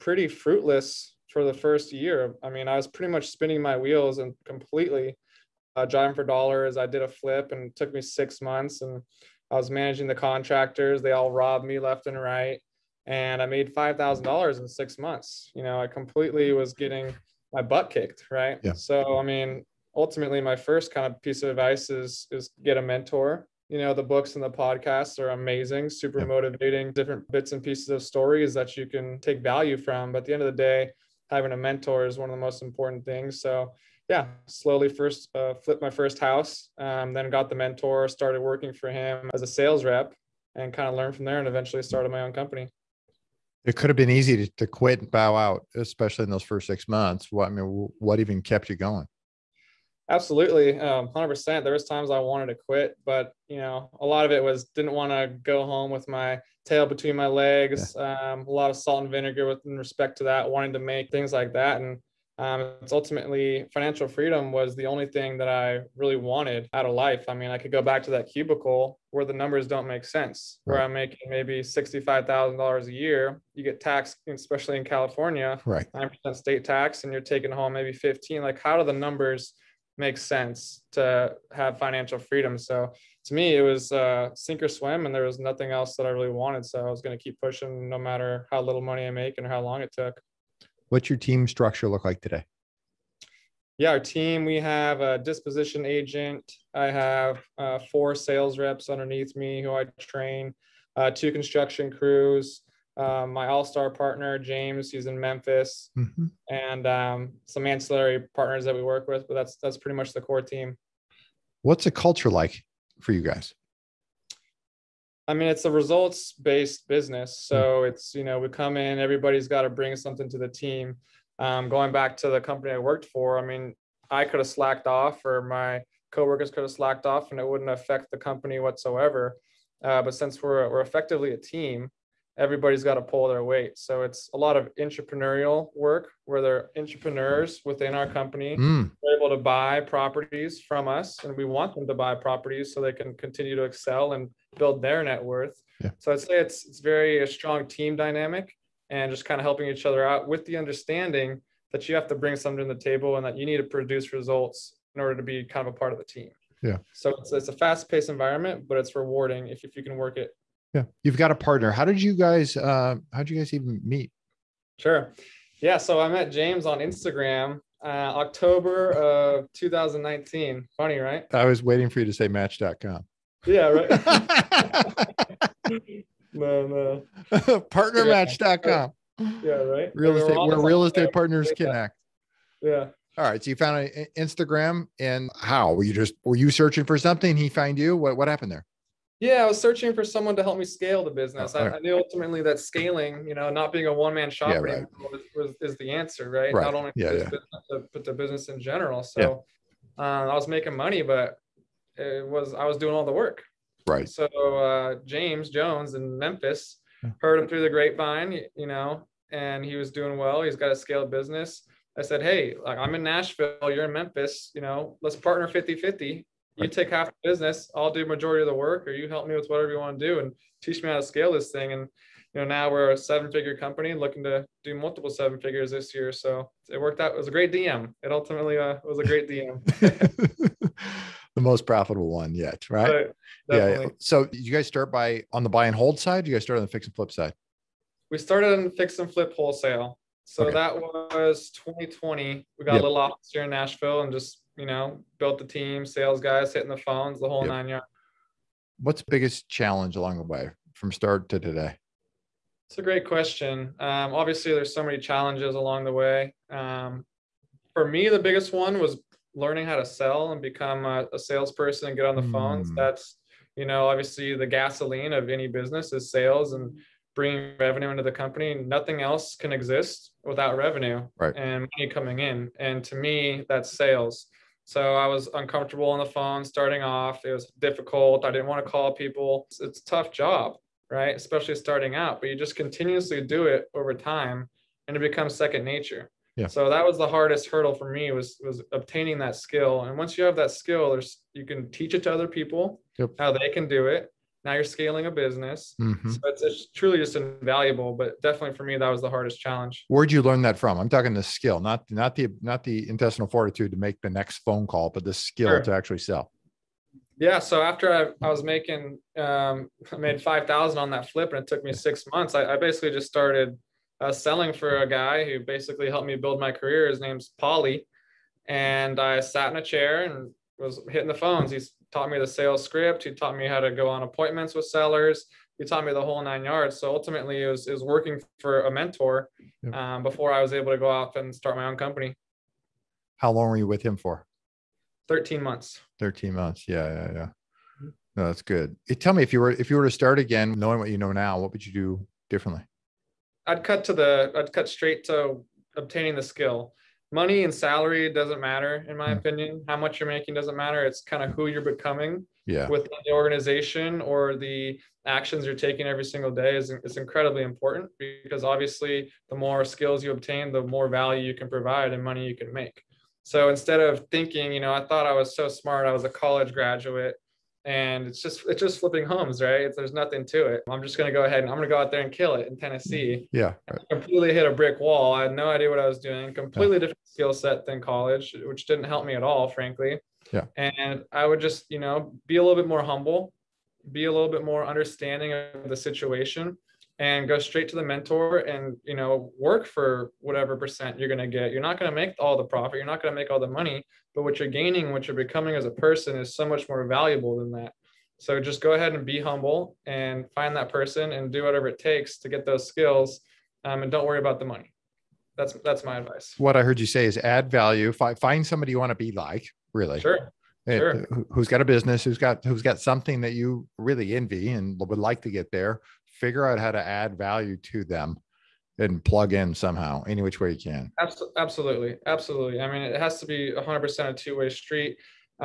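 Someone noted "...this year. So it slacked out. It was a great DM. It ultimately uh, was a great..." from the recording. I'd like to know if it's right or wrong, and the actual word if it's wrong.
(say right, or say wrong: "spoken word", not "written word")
wrong: "worked", not "slacked".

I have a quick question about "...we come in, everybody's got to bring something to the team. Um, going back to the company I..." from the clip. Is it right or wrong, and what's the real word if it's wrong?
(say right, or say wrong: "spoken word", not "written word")
right.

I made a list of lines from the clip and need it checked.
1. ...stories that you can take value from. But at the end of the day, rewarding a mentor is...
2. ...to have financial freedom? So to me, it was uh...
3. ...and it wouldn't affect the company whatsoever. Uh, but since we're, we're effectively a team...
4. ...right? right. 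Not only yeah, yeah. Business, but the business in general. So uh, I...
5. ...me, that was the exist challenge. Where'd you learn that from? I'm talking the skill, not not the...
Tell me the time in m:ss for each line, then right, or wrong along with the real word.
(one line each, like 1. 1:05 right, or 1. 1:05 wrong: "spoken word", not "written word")
1. 0:28 wrong: "having", not "rewarding"
2. 1:20 right
3. 2:07 right
4. 3:16 right
5. 4:58 wrong: "hardest", not "exist".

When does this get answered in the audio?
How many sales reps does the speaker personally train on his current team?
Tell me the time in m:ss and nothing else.
1:37.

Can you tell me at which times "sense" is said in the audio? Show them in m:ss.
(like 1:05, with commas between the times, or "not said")
1:10, 1:20.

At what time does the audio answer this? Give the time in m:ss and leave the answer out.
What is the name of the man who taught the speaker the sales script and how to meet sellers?
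5:17.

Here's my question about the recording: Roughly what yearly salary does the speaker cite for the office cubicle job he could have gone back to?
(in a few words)
$65,000.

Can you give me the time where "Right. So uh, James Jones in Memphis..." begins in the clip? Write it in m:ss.
3:23.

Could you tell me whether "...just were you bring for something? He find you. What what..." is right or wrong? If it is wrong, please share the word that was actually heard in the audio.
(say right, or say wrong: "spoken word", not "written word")
wrong: "searching", not "bring".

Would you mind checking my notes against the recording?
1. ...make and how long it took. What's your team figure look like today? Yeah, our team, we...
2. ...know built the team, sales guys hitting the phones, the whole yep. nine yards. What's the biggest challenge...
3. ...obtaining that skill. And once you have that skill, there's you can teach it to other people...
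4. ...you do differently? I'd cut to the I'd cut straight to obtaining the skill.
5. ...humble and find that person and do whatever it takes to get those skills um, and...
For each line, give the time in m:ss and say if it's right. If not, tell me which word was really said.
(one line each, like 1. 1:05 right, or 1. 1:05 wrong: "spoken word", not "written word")
1. 1:29 wrong: "structure", not "figure"
2. 4:04 right
3. 4:48 right
4. 5:41 right
5. 6:39 right.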